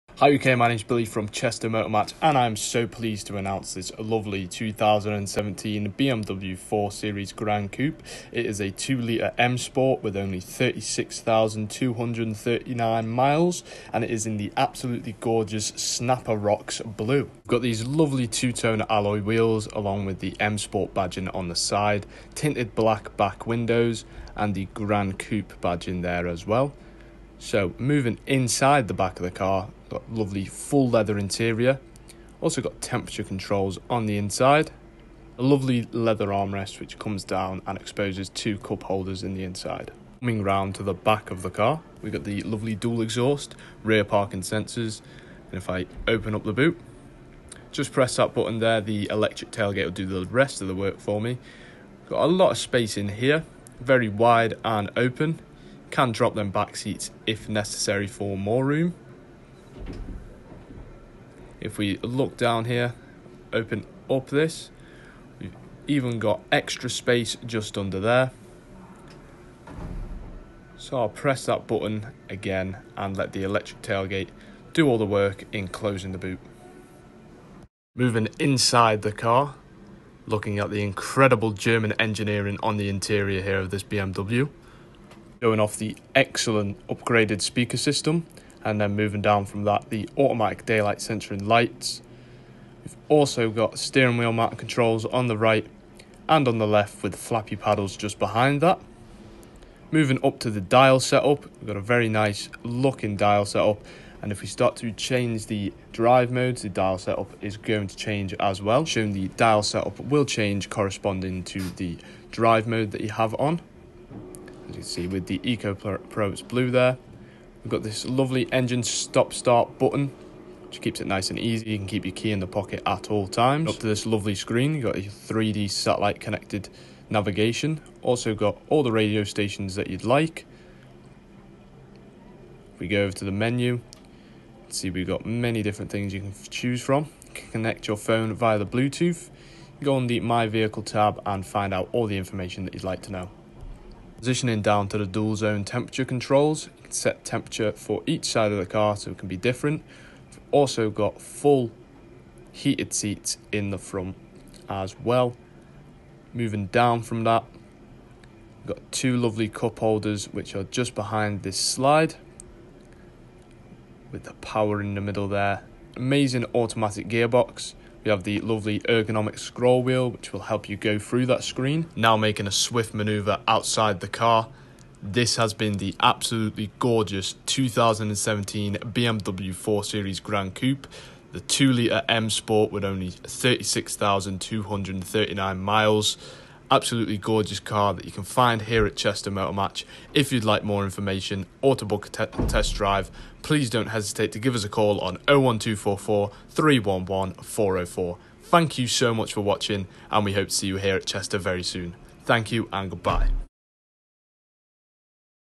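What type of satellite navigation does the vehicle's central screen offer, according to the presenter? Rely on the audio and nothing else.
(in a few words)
3D.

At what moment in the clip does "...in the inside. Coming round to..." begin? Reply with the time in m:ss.
0:39.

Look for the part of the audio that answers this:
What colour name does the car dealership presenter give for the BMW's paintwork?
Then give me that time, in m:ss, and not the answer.
0:15.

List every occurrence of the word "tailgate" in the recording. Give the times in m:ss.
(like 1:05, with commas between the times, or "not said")
0:49, 1:13.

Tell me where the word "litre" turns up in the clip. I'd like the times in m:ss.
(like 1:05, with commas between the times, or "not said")
0:08, 3:01.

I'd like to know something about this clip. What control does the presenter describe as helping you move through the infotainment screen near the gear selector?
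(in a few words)
Ergonomic scroll wheel.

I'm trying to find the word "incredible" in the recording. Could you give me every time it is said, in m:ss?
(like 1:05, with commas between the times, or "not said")
1:20.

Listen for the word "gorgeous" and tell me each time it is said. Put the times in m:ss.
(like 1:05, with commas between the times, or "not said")
0:15, 2:56, 3:07.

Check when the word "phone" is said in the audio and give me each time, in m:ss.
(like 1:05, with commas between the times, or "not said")
2:17.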